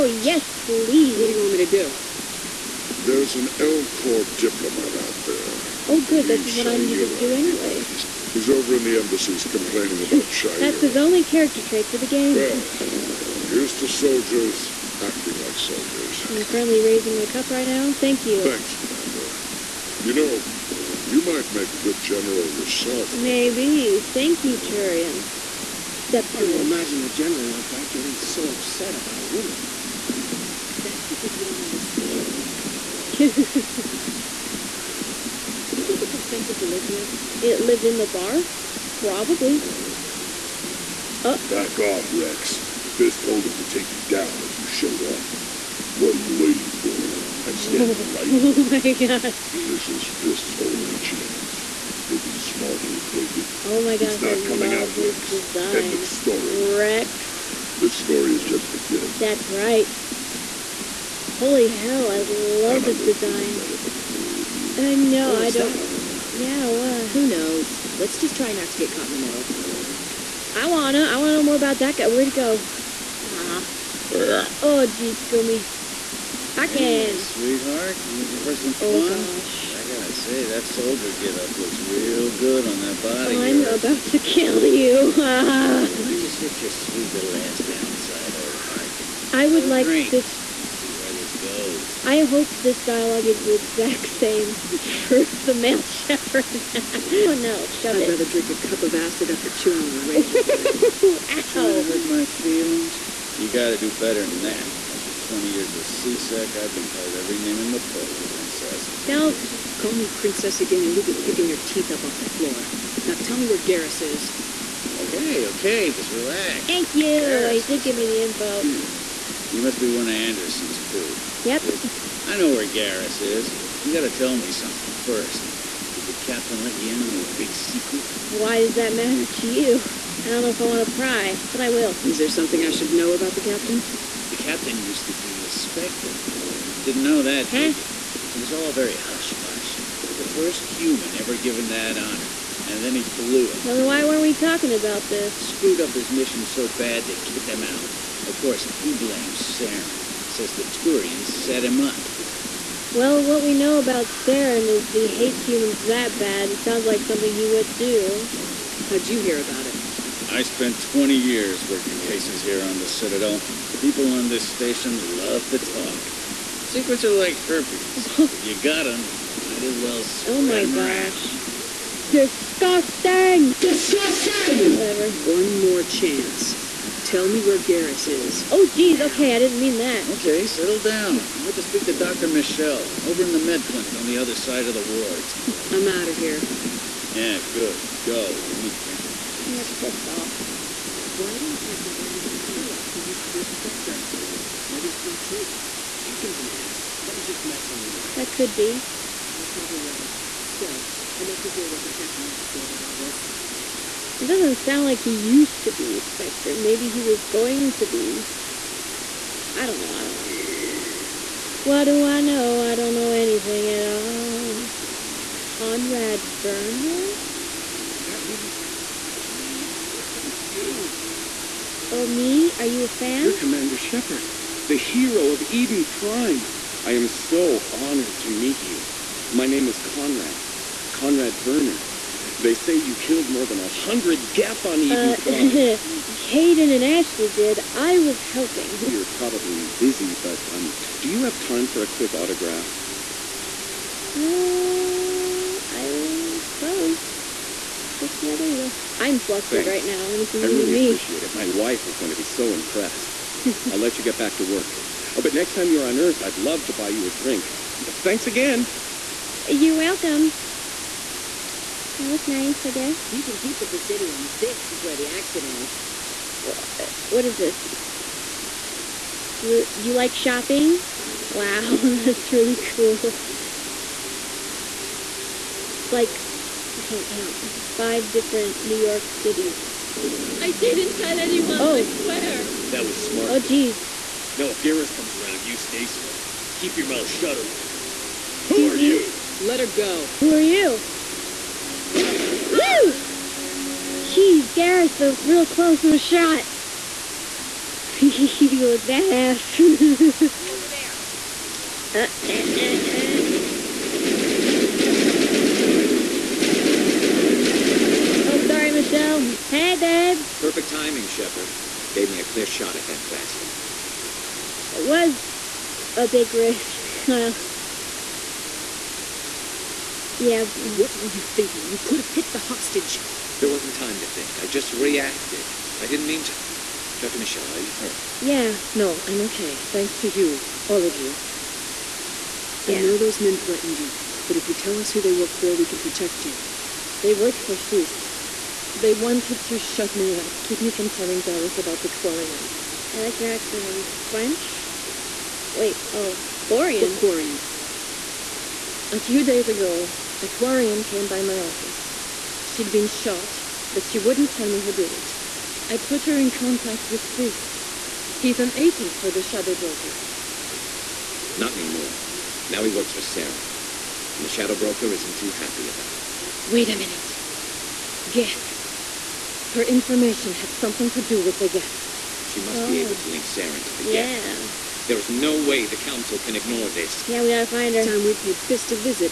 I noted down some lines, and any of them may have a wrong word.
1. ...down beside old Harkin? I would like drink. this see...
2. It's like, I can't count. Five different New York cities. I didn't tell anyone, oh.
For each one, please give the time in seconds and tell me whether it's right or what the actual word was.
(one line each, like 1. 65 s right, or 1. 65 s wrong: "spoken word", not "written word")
1. 87 s right
2. 275 s right.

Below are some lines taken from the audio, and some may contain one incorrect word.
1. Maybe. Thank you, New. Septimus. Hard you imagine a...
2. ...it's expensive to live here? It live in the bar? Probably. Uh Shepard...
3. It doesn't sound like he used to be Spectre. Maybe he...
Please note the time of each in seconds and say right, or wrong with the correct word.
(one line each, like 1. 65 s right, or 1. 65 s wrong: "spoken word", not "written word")
1. 23 s wrong: "Turian", not "New"
2. 36 s wrong: "Back", not "Shepard"
3. 203 s right.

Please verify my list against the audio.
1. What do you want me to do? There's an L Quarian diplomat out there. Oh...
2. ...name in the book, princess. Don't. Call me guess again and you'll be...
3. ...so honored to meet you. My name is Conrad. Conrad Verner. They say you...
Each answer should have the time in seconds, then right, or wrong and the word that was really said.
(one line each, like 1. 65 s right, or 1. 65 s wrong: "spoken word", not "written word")
1. 1 s wrong: "Corps", not "Quarian"
2. 107 s wrong: "princess", not "guess"
3. 227 s right.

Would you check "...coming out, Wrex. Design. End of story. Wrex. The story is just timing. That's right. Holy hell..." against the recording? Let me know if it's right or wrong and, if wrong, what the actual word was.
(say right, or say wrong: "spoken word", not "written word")
wrong: "beginning", not "timing".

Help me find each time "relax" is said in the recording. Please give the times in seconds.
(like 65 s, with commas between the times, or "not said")
116 s.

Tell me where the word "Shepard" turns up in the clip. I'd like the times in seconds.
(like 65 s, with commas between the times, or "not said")
95 s, 223 s, 311 s.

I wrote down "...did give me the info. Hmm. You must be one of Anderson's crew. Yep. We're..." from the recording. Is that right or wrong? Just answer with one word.
right.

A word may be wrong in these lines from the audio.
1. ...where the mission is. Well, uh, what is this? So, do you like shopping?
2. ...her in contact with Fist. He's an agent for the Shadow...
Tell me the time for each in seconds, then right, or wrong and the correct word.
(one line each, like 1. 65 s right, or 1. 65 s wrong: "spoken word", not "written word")
1. 264 s wrong: "action", not "mission"
2. 356 s right.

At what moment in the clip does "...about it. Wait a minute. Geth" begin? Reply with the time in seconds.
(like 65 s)
365 s.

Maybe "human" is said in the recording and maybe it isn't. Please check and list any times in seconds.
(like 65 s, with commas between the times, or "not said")
140 s, 155 s.